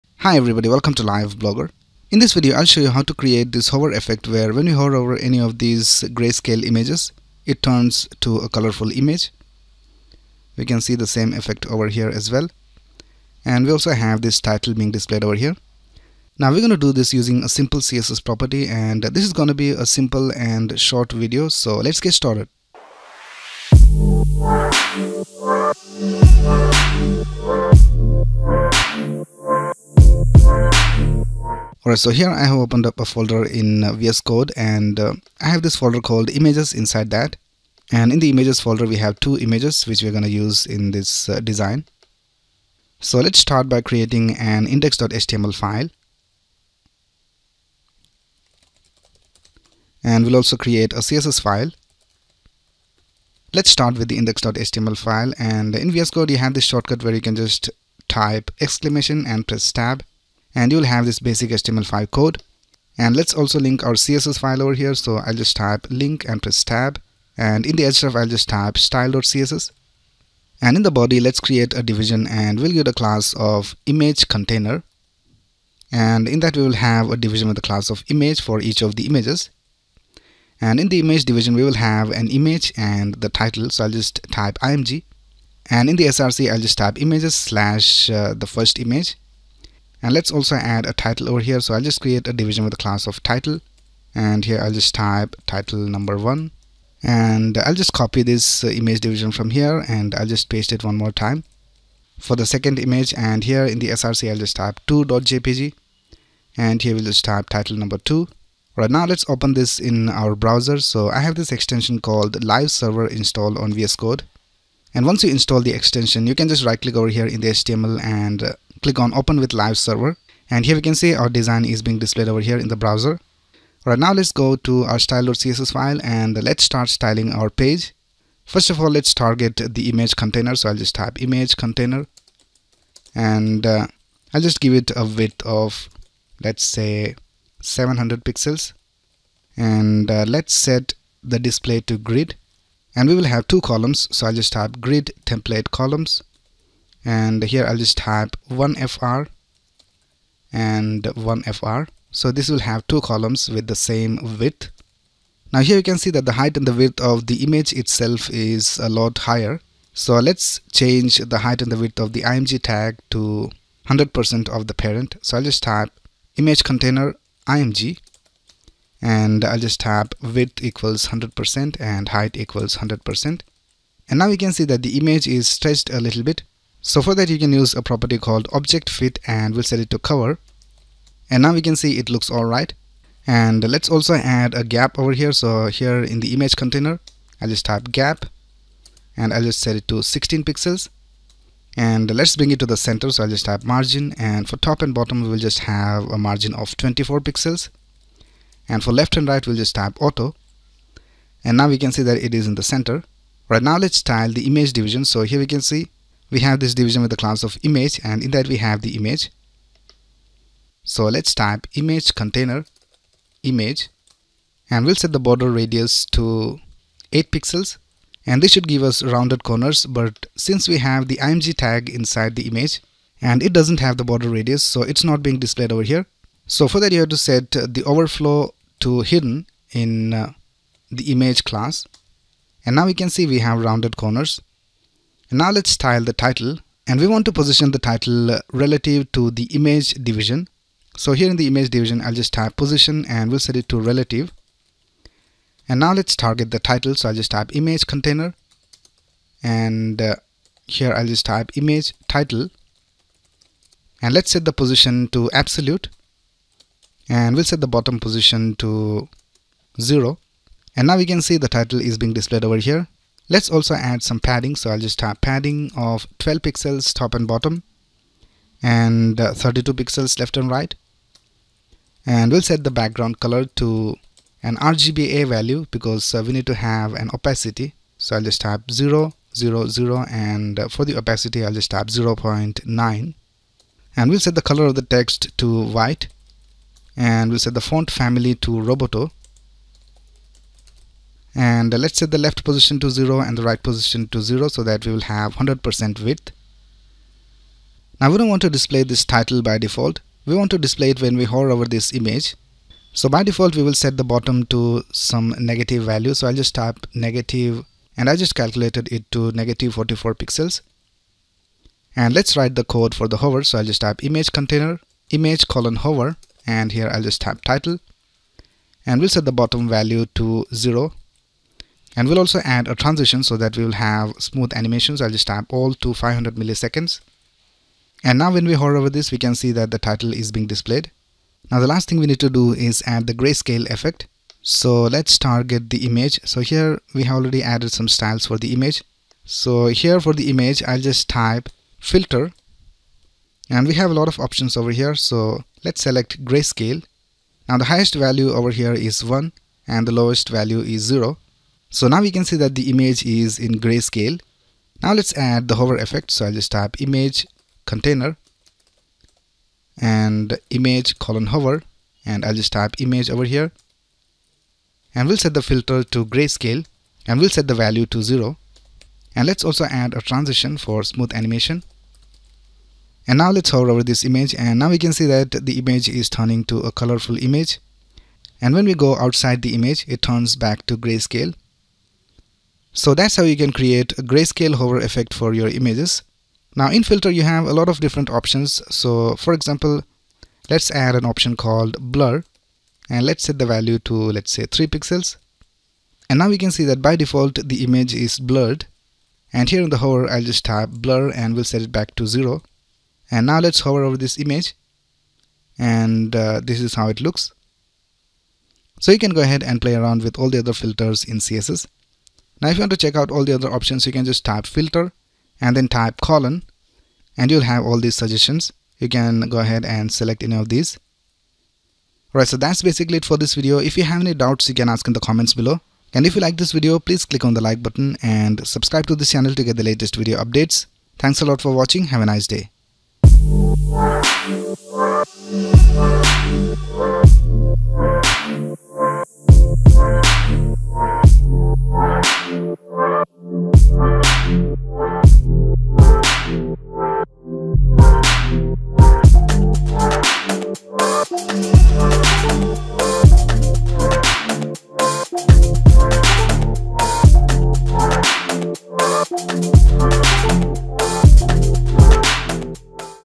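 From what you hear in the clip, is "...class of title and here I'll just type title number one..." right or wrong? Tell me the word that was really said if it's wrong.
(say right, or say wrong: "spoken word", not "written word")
right.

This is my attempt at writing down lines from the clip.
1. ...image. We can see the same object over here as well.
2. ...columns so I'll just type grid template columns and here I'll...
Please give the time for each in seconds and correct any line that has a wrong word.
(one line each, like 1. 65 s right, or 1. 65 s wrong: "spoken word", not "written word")
1. 8 s wrong: "effect", not "object"
2. 143 s right.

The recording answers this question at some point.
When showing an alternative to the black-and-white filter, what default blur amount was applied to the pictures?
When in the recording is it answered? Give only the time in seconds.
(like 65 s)
394 s.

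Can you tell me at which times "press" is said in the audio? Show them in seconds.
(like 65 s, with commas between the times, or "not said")
59 s, 66 s.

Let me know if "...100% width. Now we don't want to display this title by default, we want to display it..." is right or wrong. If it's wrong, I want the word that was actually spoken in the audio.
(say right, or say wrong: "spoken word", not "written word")
right.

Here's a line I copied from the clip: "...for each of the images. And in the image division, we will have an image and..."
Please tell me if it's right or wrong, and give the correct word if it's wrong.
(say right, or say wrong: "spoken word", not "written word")
right.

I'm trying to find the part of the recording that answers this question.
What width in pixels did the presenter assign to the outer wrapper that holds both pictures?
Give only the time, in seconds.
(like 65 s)
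137 s.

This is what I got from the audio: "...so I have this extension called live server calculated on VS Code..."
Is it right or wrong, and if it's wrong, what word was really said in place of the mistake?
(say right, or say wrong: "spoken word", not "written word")
wrong: "installed", not "calculated".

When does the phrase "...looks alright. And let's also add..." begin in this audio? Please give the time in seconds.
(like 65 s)
182 s.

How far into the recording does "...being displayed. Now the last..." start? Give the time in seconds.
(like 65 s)
330 s.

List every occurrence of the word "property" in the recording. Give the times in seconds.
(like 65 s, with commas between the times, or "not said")
18 s, 177 s.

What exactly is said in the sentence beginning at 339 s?
So here for the image, I'll just type filter.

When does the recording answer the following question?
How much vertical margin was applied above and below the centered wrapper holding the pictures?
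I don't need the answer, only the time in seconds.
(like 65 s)
196 s.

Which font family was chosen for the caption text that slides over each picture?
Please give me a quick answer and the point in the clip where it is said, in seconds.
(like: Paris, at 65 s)
Roboto, at 288 s.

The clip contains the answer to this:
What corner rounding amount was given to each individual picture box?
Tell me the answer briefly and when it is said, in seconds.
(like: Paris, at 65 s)
8 pixels, at 217 s.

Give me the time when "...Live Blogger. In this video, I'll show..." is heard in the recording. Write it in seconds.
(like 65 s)
1 s.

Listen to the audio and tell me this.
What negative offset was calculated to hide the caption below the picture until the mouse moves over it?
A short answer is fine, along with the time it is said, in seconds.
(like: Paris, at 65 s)
-44 pixels, at 309 s.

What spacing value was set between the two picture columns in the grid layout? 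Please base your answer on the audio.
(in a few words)
16 pixels.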